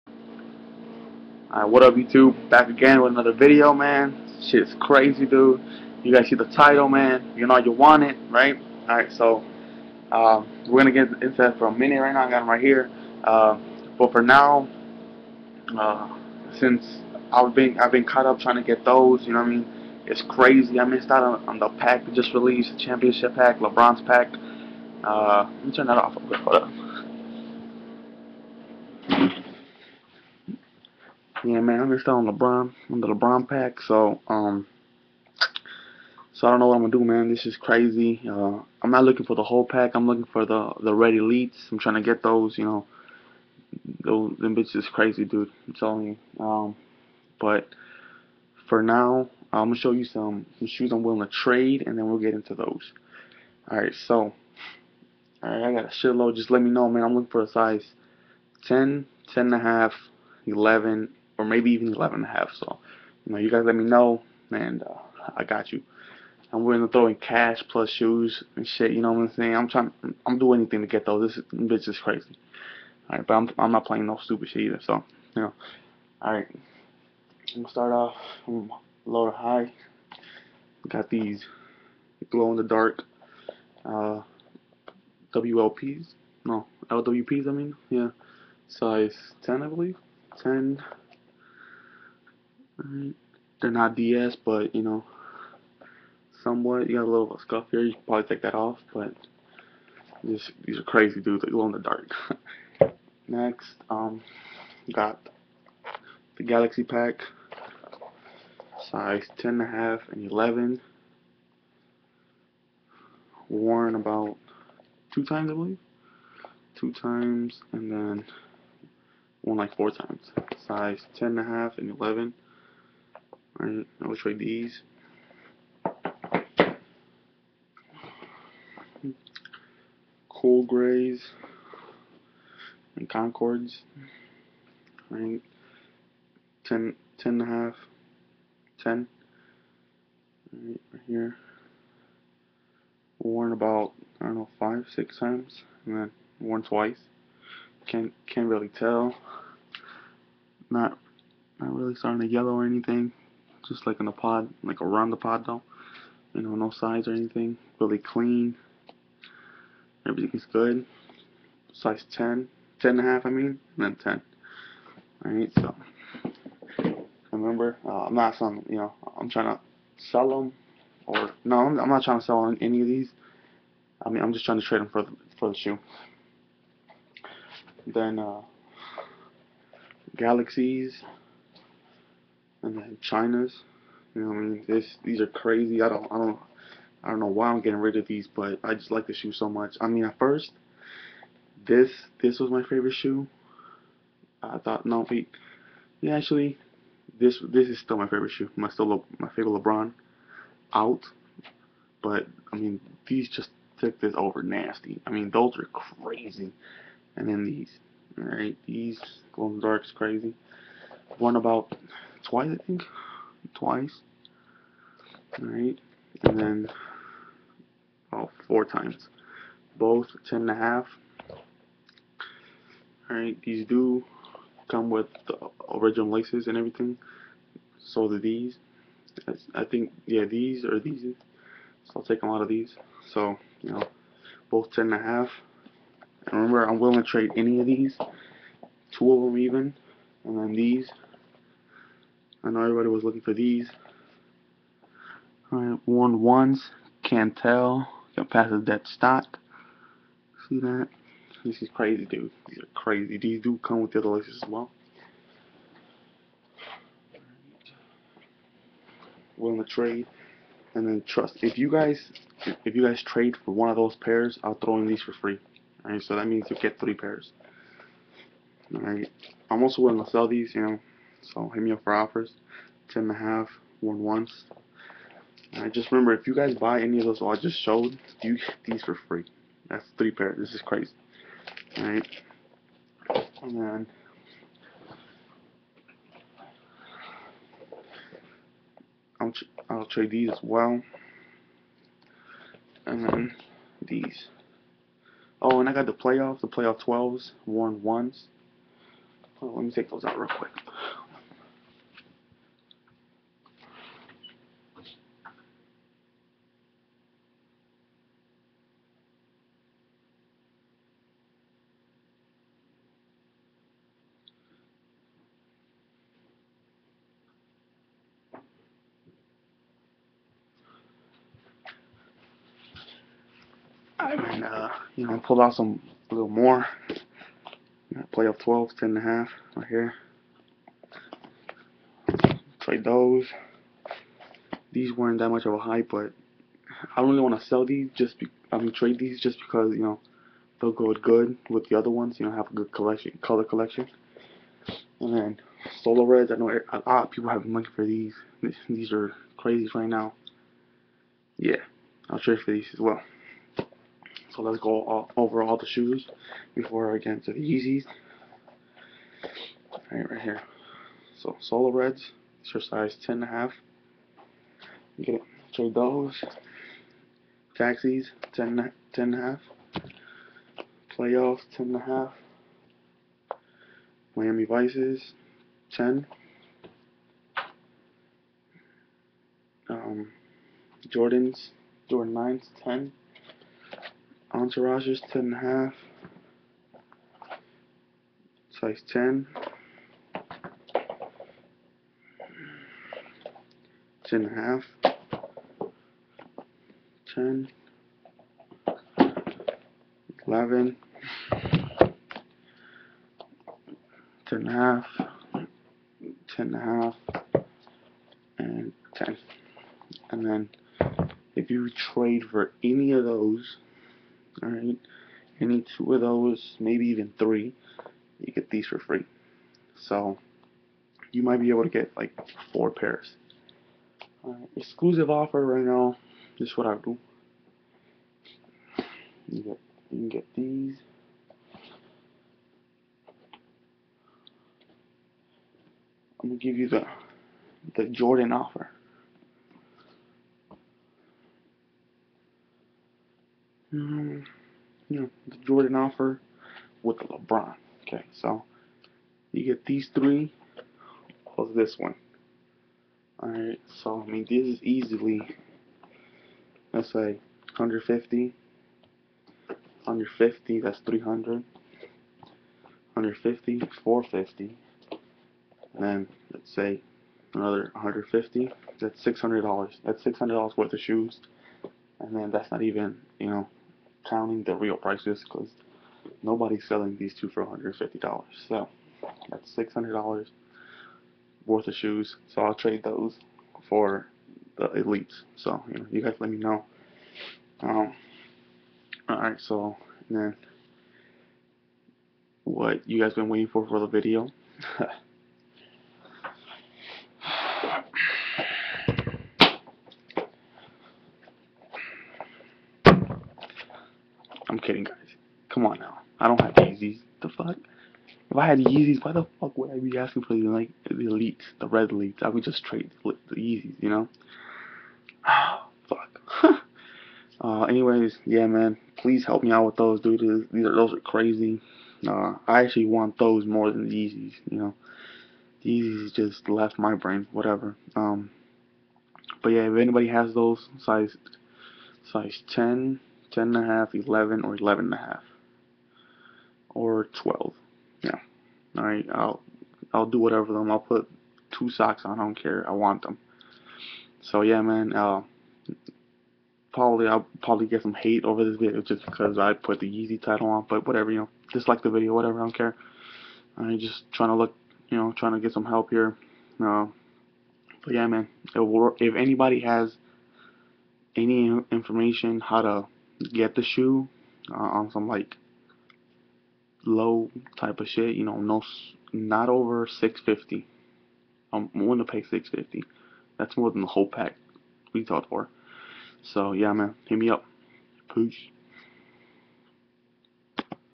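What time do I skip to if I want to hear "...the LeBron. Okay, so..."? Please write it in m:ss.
7:26.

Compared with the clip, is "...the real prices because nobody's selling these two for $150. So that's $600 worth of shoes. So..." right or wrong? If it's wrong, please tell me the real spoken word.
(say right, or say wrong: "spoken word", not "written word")
right.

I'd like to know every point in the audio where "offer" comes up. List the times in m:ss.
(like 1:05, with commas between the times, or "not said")
4:31, 7:05, 7:18, 7:25.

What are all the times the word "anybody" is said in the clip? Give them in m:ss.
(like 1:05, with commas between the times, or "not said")
8:49, 9:19.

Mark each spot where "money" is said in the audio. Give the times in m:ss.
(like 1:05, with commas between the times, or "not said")
5:47.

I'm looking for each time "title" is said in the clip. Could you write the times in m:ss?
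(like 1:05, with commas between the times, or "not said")
0:06, 9:10.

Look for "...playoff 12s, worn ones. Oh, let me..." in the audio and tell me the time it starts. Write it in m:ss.
4:56.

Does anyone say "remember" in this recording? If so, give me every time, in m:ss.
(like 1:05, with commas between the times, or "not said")
2:47, 3:56, 4:35.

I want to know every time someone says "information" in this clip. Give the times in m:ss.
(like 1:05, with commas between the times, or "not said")
9:21.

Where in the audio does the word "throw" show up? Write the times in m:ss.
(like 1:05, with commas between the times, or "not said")
1:06, 4:24.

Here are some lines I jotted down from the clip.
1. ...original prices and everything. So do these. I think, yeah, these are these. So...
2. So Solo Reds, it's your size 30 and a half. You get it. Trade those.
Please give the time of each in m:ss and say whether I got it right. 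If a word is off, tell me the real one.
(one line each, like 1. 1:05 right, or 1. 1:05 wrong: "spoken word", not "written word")
1. 3:45 wrong: "laces", not "prices"
2. 6:01 wrong: "10", not "30".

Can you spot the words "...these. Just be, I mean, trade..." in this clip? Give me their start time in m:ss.
5:37.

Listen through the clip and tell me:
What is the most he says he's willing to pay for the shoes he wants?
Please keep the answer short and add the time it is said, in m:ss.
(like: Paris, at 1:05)
$650, at 9:31.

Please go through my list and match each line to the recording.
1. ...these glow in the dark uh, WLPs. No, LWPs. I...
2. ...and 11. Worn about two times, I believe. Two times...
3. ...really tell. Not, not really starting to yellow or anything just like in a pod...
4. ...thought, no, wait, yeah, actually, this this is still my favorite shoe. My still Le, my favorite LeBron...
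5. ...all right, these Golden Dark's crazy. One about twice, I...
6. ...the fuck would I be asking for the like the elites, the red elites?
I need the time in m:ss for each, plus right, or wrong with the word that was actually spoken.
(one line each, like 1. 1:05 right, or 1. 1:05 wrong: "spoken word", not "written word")
1. 1:21 right
2. 1:50 right
3. 2:28 right
4. 3:14 right
5. 3:28 right
6. 8:29 right.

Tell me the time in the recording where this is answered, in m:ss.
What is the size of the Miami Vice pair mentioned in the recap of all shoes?
6:14.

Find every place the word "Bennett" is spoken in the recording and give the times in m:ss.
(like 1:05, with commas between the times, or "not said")
not said.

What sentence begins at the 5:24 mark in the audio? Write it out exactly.
and uh, you know, pulled out some a little more.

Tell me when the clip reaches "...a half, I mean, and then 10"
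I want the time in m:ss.
2:42.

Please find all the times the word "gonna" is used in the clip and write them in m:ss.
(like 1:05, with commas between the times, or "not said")
0:36, 0:49, 1:17, 7:16.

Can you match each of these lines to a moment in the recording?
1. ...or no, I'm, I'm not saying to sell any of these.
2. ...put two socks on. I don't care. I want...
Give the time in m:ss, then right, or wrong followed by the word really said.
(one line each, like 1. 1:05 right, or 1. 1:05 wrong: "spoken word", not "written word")
1. 2:51 wrong: "trying", not "saying"
2. 9:00 right.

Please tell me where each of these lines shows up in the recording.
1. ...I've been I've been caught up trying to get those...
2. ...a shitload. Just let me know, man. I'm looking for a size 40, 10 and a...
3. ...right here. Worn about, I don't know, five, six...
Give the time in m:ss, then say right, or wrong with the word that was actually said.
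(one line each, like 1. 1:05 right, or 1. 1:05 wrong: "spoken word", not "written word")
1. 0:17 right
2. 0:55 wrong: "10", not "40"
3. 2:20 right.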